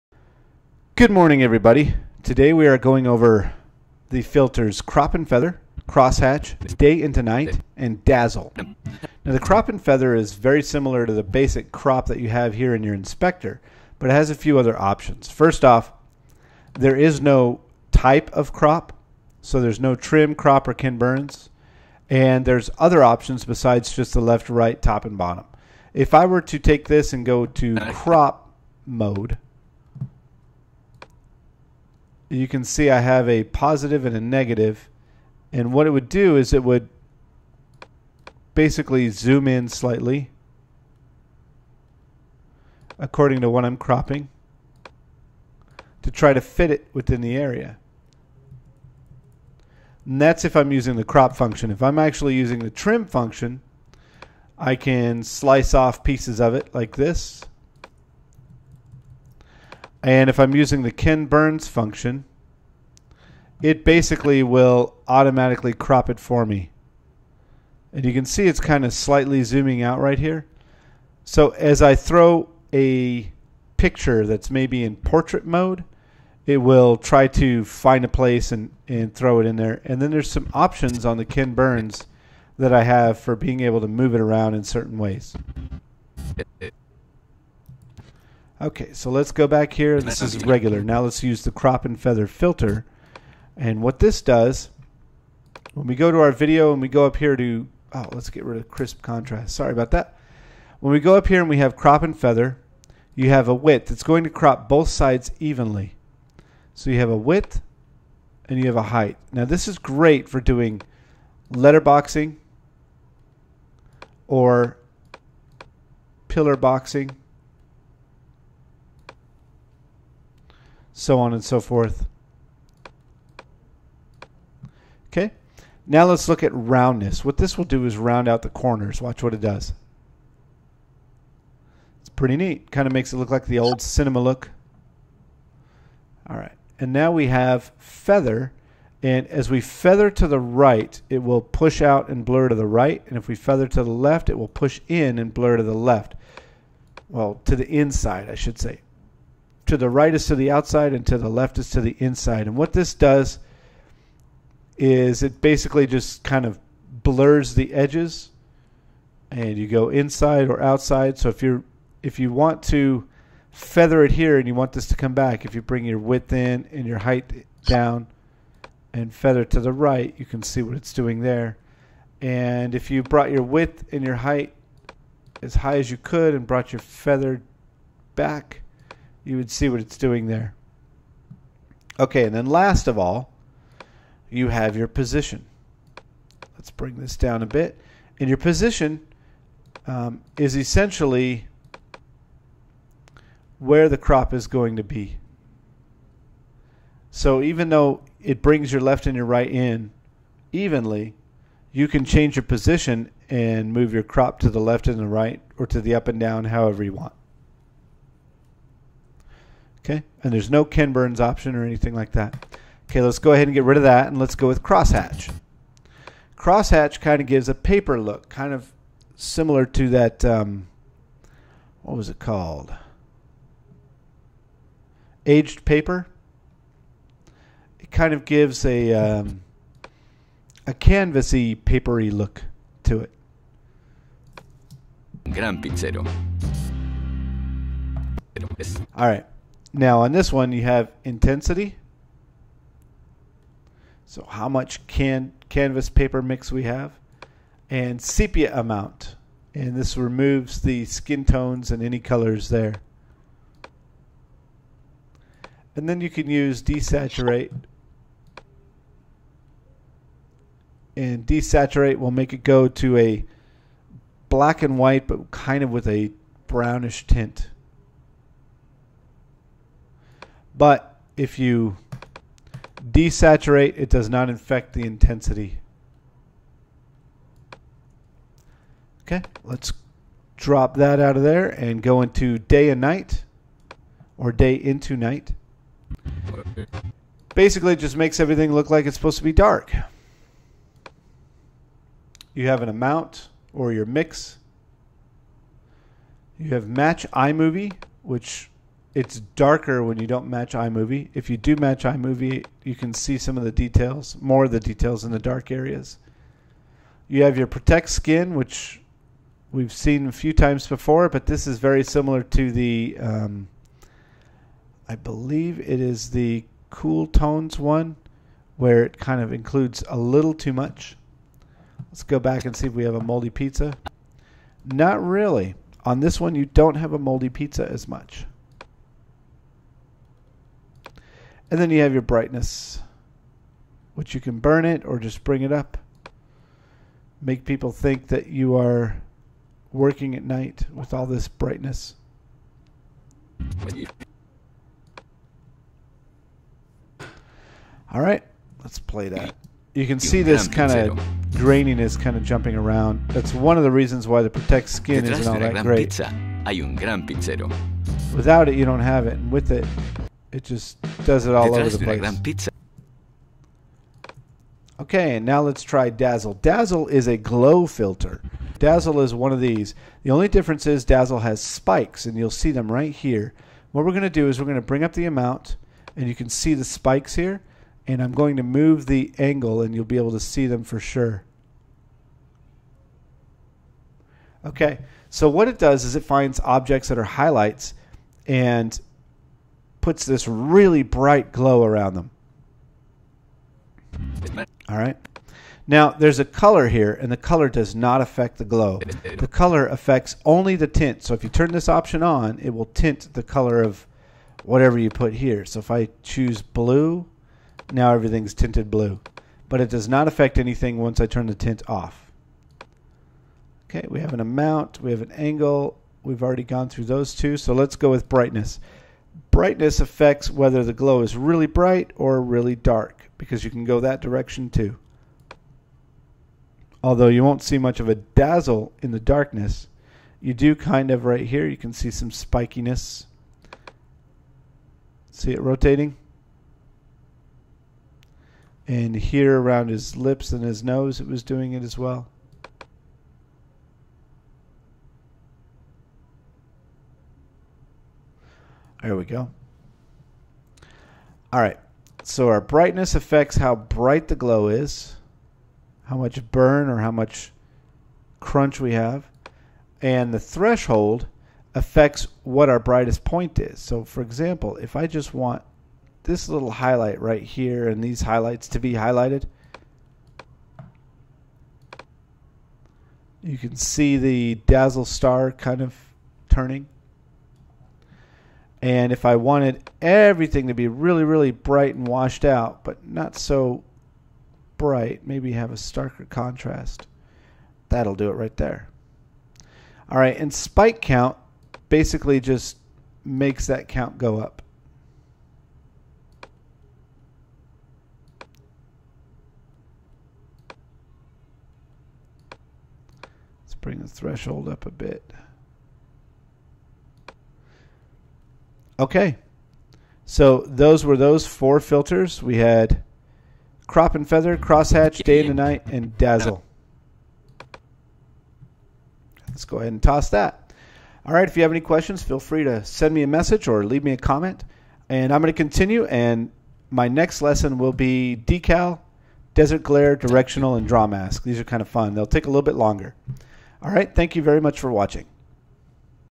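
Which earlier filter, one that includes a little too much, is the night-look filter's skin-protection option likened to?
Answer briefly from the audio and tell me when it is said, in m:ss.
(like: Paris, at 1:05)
Cool tones, at 5:16.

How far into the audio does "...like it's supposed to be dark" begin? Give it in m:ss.
4:48.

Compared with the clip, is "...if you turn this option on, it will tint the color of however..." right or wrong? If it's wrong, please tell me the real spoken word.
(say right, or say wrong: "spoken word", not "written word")
wrong: "whatever", not "however".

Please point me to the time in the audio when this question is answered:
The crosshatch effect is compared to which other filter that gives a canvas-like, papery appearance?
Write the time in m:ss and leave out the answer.
3:45.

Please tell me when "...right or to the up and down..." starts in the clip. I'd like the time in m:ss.
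3:25.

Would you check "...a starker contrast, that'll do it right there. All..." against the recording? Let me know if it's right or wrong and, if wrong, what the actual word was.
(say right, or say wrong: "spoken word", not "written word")
right.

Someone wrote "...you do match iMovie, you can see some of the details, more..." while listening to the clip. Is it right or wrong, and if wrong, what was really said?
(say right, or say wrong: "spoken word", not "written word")
right.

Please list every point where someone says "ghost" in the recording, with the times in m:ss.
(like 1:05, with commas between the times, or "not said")
not said.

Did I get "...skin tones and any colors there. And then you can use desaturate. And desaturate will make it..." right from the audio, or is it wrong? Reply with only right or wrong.
right.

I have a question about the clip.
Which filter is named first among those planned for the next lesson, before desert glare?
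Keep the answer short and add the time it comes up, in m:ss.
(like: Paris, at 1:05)
Decal, at 8:48.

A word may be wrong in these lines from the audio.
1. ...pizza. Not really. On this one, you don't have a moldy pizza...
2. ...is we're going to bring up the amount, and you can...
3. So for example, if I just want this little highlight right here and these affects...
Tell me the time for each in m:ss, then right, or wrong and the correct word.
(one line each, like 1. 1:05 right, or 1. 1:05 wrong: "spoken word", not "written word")
1. 5:23 right
2. 6:14 right
3. 7:43 wrong: "highlights", not "affects".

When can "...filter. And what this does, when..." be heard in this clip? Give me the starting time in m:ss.
1:32.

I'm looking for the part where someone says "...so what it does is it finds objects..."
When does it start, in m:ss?
6:25.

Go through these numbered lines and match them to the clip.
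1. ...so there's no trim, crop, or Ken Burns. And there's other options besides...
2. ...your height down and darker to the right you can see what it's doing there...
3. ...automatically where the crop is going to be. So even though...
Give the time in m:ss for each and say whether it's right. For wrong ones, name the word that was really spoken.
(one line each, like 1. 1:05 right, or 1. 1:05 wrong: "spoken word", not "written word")
1. 0:19 right
2. 2:46 wrong: "feather", not "darker"
3. 3:10 wrong: "essentially", not "automatically".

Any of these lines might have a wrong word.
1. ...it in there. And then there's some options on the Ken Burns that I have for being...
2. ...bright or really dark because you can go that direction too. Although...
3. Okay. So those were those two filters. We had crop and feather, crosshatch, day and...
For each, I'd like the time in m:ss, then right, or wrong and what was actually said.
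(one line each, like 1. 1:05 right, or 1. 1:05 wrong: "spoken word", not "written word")
1. 1:19 right
2. 7:01 right
3. 8:28 wrong: "four", not "two".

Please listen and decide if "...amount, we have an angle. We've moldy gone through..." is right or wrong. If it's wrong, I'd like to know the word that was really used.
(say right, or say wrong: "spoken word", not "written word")
wrong: "already", not "moldy".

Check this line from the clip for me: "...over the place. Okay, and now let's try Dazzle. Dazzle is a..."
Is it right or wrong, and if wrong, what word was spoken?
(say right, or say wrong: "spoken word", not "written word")
right.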